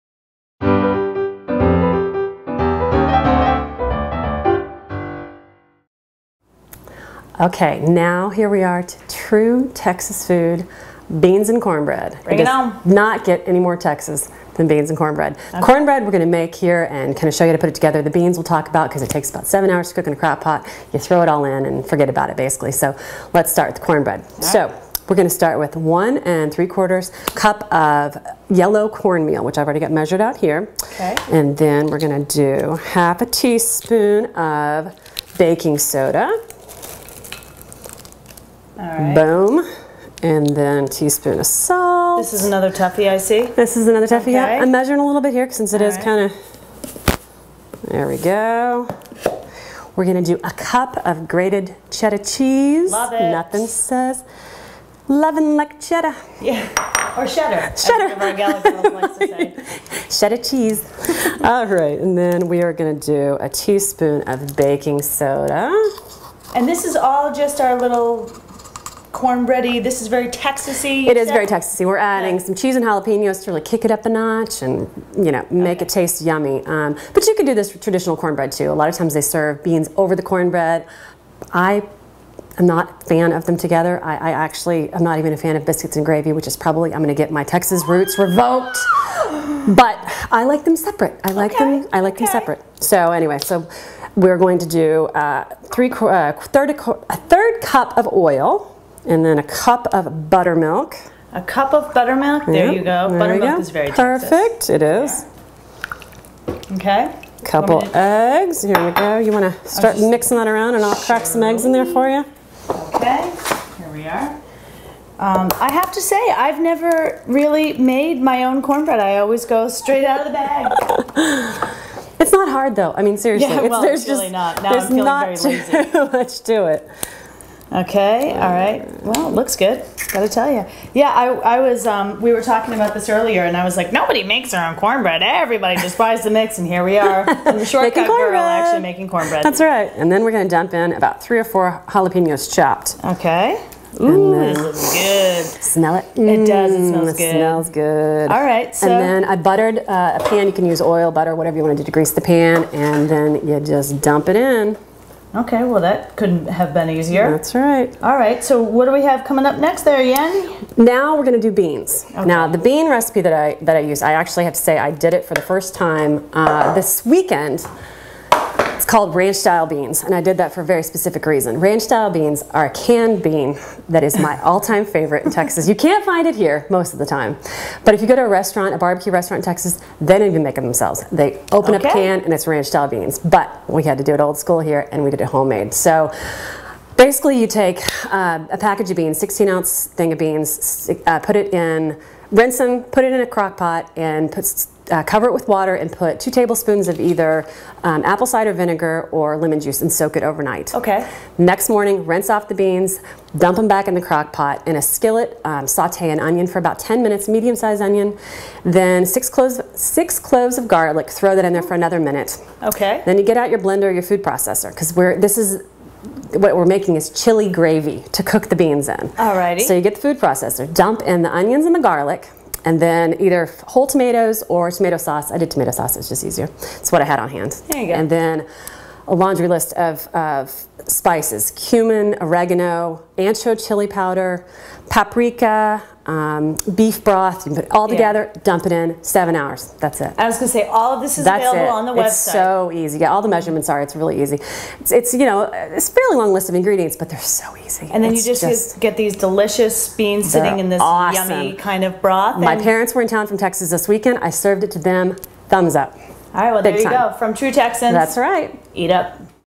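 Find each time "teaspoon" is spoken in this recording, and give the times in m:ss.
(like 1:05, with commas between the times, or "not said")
0:33, 0:40, 1:03.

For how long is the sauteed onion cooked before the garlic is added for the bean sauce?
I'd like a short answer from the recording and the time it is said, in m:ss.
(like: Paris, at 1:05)
10 minutes, at 3:26.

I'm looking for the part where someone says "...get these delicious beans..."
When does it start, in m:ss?
4:08.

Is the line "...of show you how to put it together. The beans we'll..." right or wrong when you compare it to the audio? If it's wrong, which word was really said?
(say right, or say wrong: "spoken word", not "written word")
right.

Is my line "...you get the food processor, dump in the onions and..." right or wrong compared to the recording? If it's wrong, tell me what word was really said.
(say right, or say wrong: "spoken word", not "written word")
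right.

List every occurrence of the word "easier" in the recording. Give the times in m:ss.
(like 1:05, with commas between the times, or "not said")
2:36, 3:46.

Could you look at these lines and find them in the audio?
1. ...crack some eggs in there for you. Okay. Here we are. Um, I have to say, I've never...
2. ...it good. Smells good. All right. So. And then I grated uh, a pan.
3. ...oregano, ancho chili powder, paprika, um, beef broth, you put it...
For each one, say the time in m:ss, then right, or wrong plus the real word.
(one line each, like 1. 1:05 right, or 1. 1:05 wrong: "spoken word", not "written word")
1. 1:50 right
2. 2:27 wrong: "buttered", not "grated"
3. 3:52 right.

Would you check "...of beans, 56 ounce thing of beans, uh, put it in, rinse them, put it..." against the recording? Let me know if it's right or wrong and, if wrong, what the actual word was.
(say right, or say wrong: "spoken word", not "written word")
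wrong: "16", not "56".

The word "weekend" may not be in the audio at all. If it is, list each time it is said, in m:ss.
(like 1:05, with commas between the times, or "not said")
2:47, 4:13.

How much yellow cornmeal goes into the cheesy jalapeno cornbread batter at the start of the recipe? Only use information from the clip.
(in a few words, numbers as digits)
1 3/4 cups.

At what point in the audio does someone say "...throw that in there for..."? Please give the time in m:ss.
3:31.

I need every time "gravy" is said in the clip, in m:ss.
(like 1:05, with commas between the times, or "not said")
1:26, 3:37.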